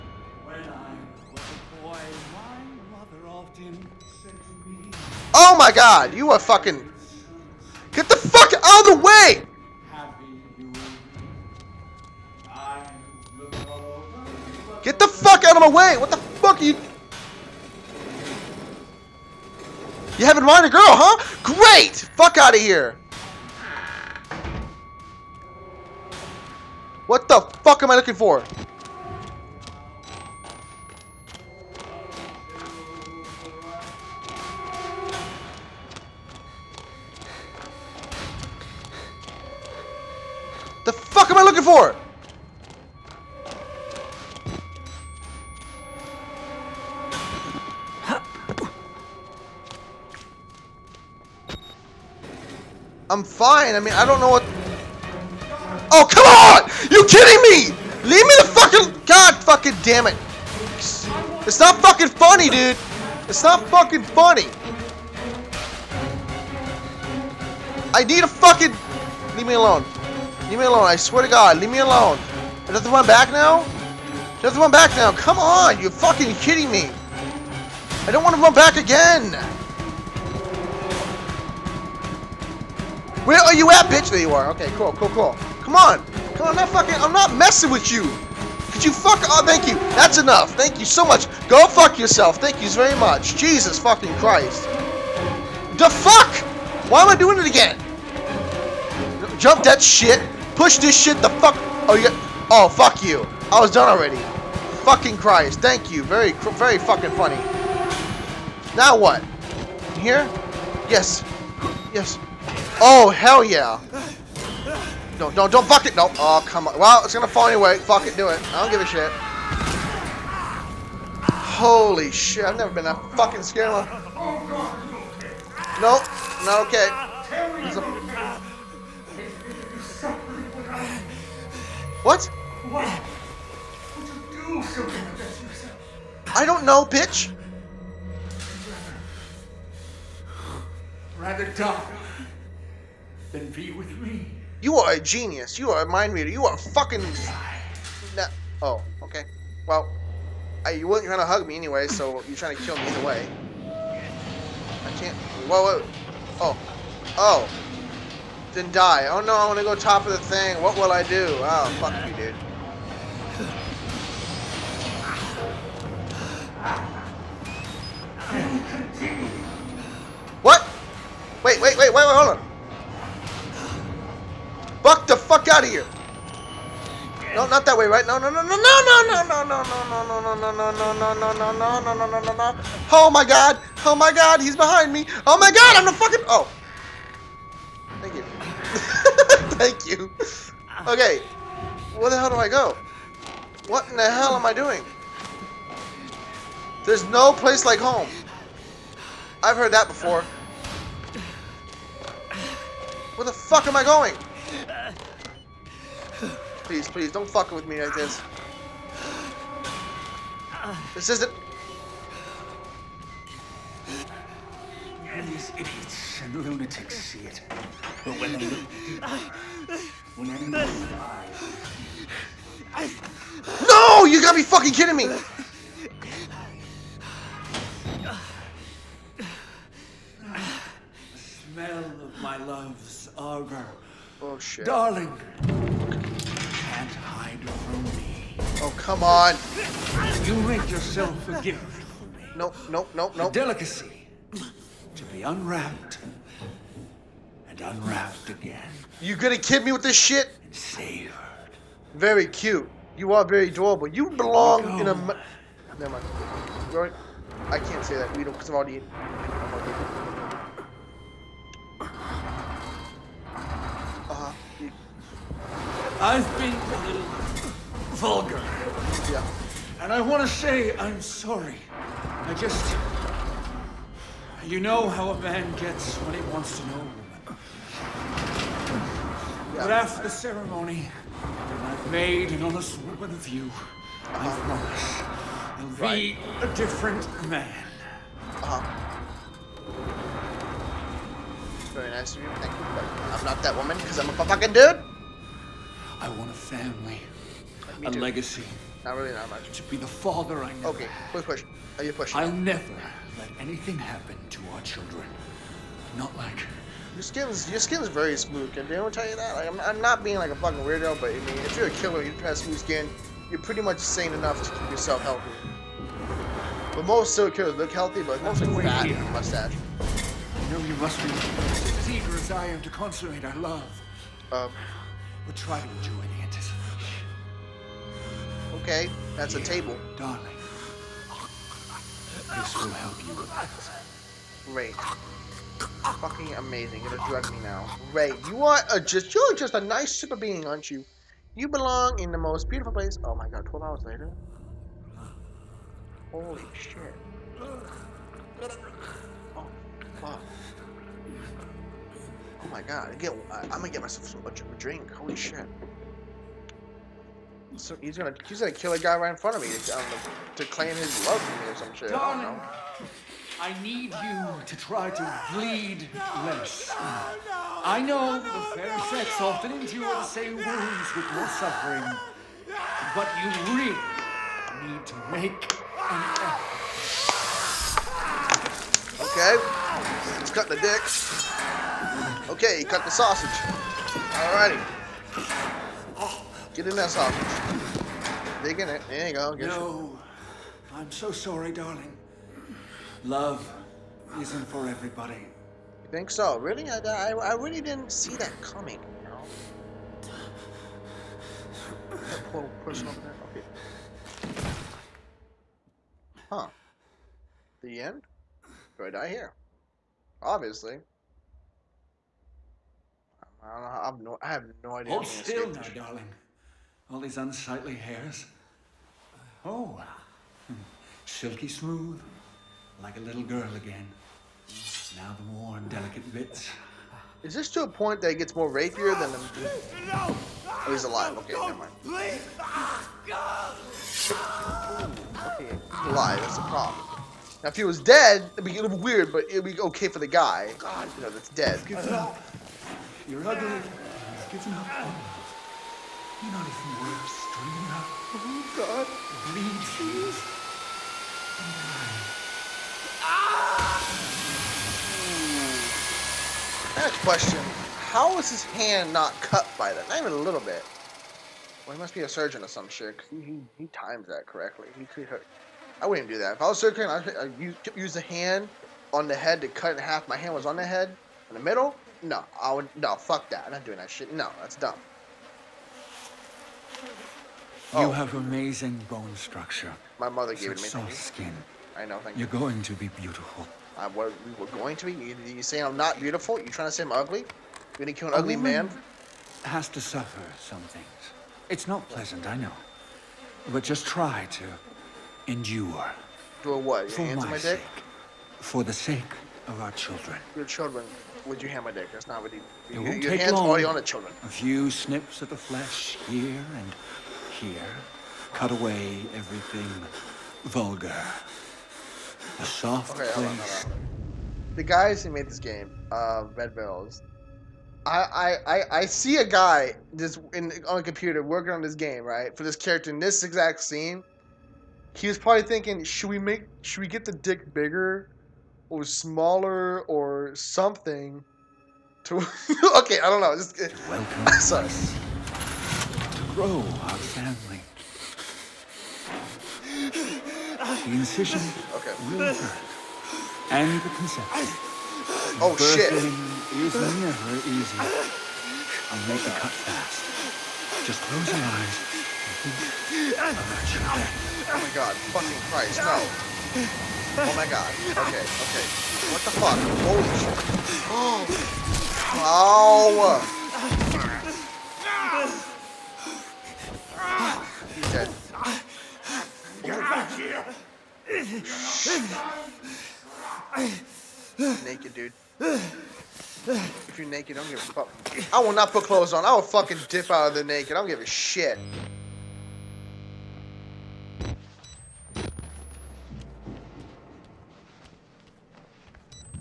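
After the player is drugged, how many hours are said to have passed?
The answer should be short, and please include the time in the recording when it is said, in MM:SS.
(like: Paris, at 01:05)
12, at 05:43.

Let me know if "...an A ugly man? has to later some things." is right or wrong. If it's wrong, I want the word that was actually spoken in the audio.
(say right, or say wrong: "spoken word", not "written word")
wrong: "suffer", not "later".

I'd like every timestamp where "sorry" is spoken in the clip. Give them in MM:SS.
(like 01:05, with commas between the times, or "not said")
04:31, 06:31, 08:54.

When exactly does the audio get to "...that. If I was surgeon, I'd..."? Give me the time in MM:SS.
07:46.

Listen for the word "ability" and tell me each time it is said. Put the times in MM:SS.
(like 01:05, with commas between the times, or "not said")
not said.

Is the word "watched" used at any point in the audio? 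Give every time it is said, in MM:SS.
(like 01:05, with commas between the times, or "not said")
not said.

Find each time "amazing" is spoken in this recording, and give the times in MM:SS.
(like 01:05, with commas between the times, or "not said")
05:36, 07:58.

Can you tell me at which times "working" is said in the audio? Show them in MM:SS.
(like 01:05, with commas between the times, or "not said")
08:41.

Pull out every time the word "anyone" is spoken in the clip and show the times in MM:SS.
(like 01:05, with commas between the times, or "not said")
03:40, 05:08.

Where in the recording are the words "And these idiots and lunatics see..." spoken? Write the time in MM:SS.
03:35.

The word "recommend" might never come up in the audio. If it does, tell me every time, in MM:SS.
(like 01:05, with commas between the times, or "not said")
not said.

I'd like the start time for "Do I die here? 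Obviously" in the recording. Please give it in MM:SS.
06:48.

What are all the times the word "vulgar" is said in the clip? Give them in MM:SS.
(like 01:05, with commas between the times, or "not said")
04:27, 08:30.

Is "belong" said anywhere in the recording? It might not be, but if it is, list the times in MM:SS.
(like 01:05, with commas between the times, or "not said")
04:14, 05:41.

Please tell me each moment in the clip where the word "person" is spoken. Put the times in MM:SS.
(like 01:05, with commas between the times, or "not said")
06:42.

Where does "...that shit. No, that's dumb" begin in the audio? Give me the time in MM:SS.
07:53.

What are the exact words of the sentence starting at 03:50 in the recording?
The smell of my love's arbor Oh, shit.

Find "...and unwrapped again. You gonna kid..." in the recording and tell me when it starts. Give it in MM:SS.
04:07.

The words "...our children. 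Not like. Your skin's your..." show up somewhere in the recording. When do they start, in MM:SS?
05:04.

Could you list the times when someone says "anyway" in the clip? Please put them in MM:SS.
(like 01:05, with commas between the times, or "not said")
01:57, 02:31.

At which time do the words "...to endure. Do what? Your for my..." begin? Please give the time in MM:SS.
08:14.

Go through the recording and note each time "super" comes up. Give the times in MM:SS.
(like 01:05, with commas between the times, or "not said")
05:39.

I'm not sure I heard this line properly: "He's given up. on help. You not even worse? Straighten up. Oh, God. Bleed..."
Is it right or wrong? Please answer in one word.
right.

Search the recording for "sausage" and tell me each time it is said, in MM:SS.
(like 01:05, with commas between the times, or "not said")
06:22, 06:26.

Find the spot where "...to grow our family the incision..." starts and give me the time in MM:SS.
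08:56.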